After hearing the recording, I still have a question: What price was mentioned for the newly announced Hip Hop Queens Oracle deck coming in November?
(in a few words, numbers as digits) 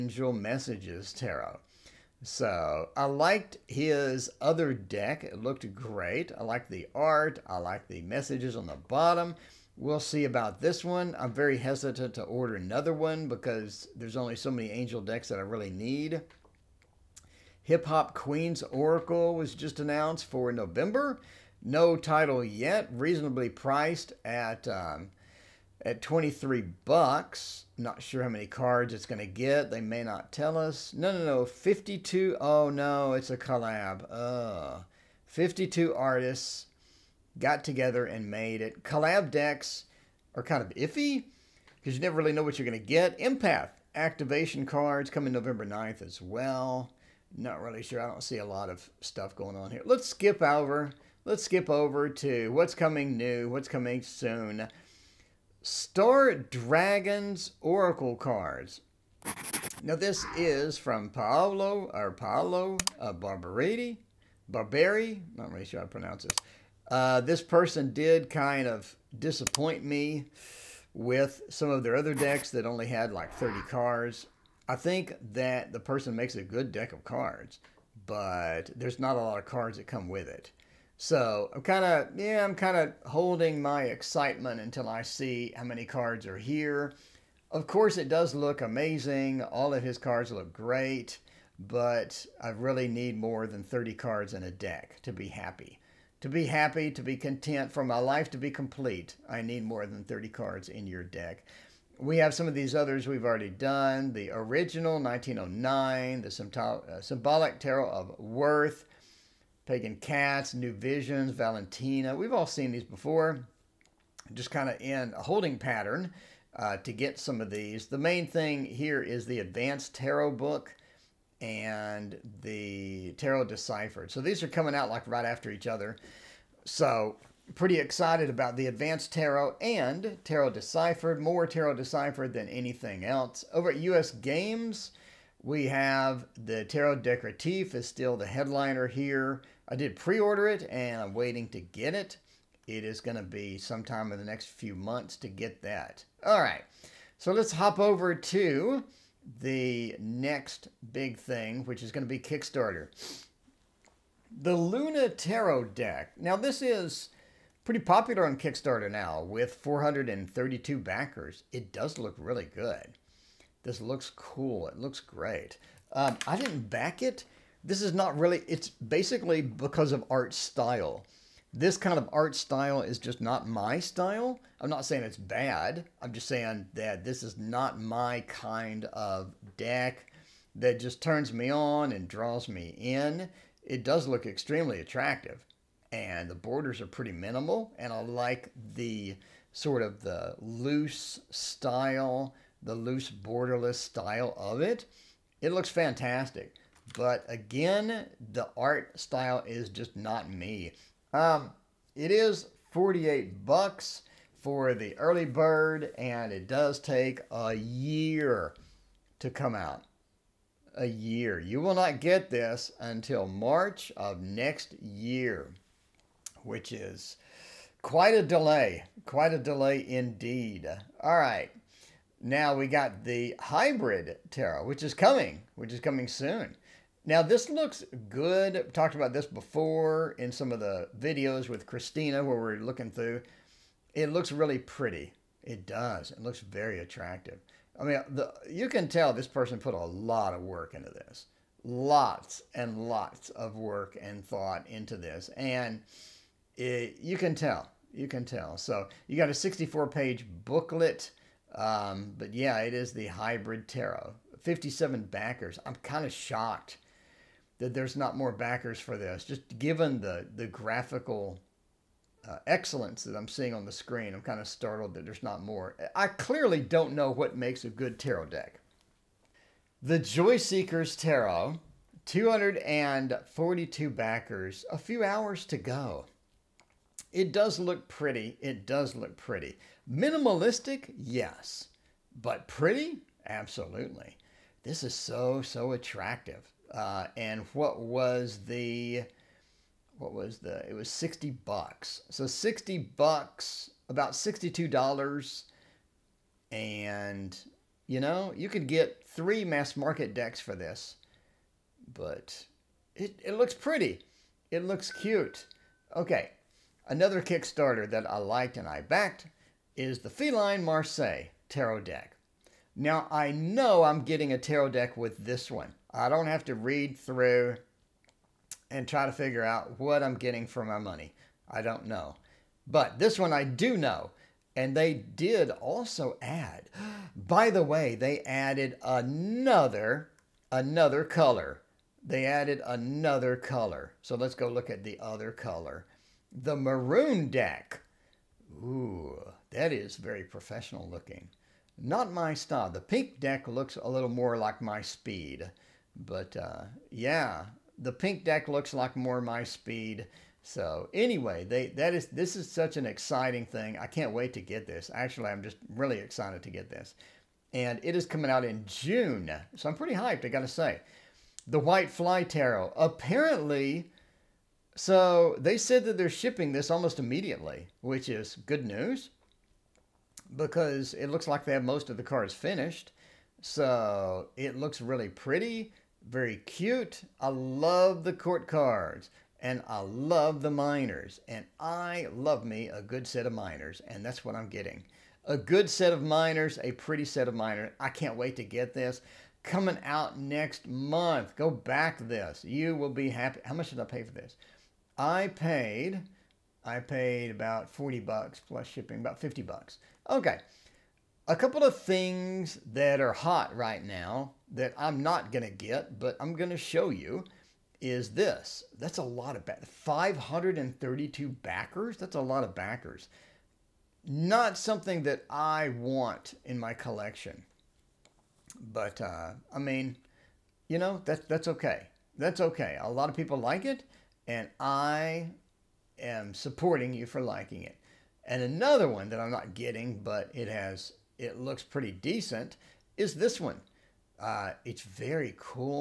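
$23.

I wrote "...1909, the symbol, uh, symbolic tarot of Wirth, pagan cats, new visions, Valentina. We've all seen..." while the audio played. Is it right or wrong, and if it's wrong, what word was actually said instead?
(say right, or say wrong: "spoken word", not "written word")
right.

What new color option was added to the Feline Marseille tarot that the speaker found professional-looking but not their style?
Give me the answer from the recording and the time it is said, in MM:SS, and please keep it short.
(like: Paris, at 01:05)
Maroon, at 05:36.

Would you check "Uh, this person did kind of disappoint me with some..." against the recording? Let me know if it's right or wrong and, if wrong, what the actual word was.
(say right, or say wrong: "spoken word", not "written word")
right.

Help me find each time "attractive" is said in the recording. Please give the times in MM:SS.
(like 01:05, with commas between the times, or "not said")
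03:04, 03:56, 04:45.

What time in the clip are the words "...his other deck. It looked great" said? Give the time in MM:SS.
00:03.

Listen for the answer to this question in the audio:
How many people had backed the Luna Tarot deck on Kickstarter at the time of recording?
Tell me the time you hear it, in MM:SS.
02:39.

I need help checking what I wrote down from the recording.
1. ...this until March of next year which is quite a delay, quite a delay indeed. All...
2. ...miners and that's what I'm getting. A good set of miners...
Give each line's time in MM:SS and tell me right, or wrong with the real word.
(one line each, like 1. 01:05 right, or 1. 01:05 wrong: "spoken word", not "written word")
1. 03:32 right
2. 06:23 right.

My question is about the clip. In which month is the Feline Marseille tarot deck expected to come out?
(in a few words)
June.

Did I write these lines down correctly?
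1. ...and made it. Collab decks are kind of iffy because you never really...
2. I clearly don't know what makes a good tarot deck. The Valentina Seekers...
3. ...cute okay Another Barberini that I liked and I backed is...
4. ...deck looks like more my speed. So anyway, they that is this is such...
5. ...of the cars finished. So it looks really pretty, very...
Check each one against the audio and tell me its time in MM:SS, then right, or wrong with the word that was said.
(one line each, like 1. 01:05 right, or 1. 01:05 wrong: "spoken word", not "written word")
1. 00:38 right
2. 04:25 wrong: "Joy", not "Valentina"
3. 05:04 wrong: "Kickstarter", not "Barberini"
4. 05:48 right
5. 06:11 right.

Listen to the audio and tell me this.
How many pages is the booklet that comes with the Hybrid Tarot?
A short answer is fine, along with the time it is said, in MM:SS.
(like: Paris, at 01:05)
64, at 04:09.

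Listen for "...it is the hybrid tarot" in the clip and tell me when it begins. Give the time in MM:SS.
04:12.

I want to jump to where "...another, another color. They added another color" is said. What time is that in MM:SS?
05:28.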